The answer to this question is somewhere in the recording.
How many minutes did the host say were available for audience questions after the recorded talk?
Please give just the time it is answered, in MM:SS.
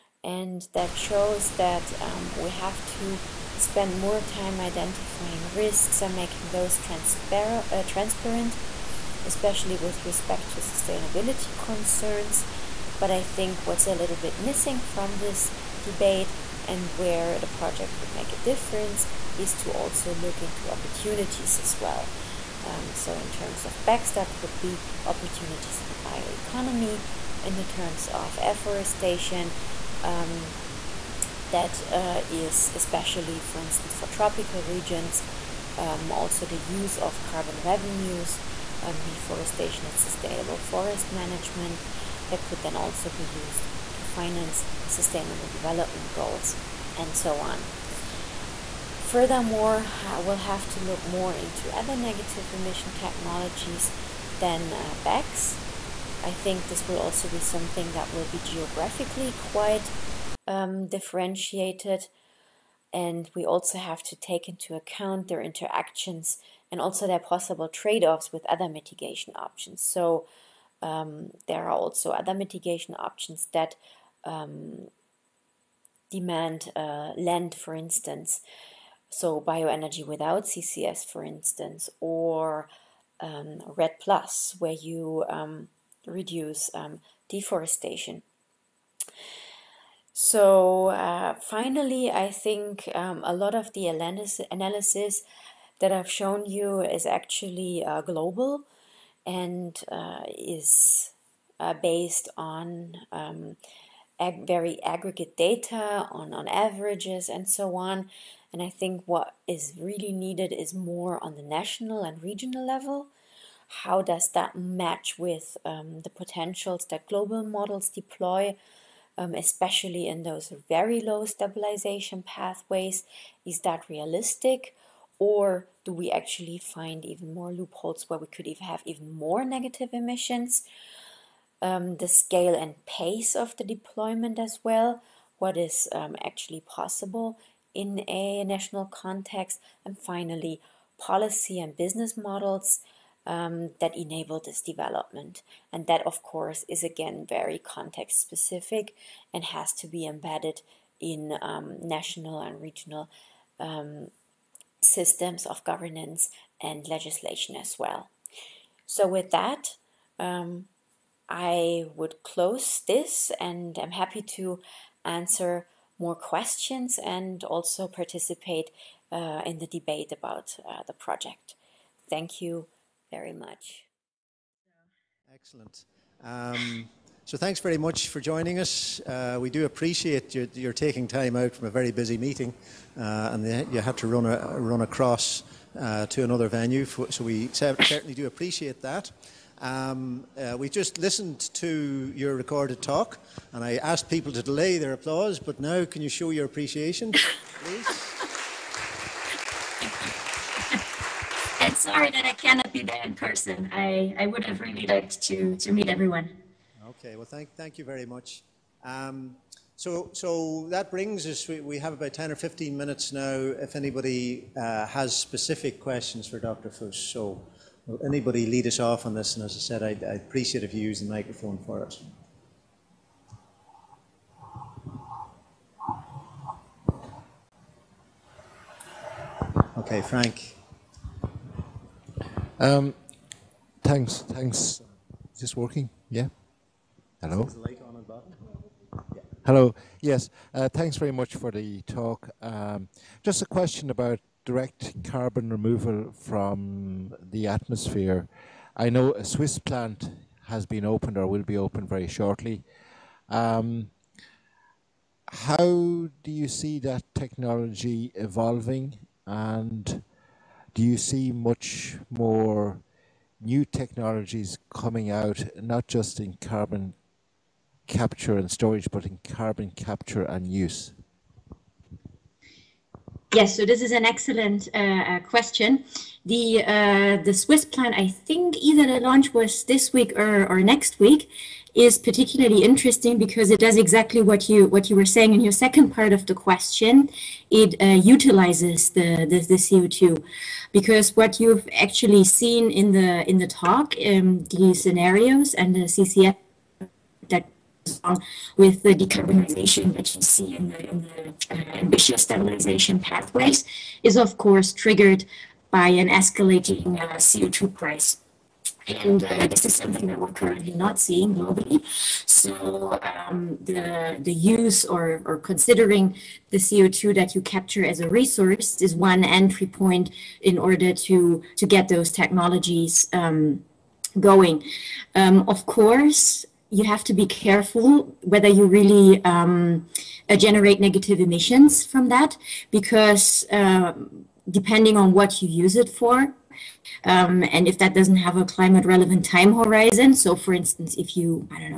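03:32.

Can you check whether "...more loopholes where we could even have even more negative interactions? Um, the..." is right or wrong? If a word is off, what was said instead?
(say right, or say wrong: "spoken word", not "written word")
wrong: "emissions", not "interactions".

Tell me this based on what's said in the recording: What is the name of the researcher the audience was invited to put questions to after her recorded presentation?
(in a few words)
Dr. Fuss.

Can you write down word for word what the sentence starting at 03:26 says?
Okay, well, thank, thank you very much.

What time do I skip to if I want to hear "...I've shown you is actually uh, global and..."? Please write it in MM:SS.
01:35.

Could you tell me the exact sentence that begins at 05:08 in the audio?
And uh, this is something that we're currently not seeing globally.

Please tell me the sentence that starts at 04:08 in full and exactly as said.
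I know a Swiss plant has been opened or will be opened very shortly.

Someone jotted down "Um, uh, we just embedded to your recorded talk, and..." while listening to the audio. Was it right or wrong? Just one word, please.
wrong.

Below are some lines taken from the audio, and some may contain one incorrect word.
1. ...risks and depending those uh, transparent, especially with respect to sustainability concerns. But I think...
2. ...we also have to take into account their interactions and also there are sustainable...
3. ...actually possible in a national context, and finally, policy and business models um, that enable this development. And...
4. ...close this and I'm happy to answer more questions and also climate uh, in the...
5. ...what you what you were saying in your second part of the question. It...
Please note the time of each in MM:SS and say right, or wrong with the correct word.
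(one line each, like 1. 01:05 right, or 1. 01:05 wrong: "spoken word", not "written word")
1. 00:05 wrong: "making", not "depending"
2. 01:03 wrong: "possible", not "sustainable"
3. 02:16 right
4. 02:42 wrong: "participate", not "climate"
5. 04:44 right.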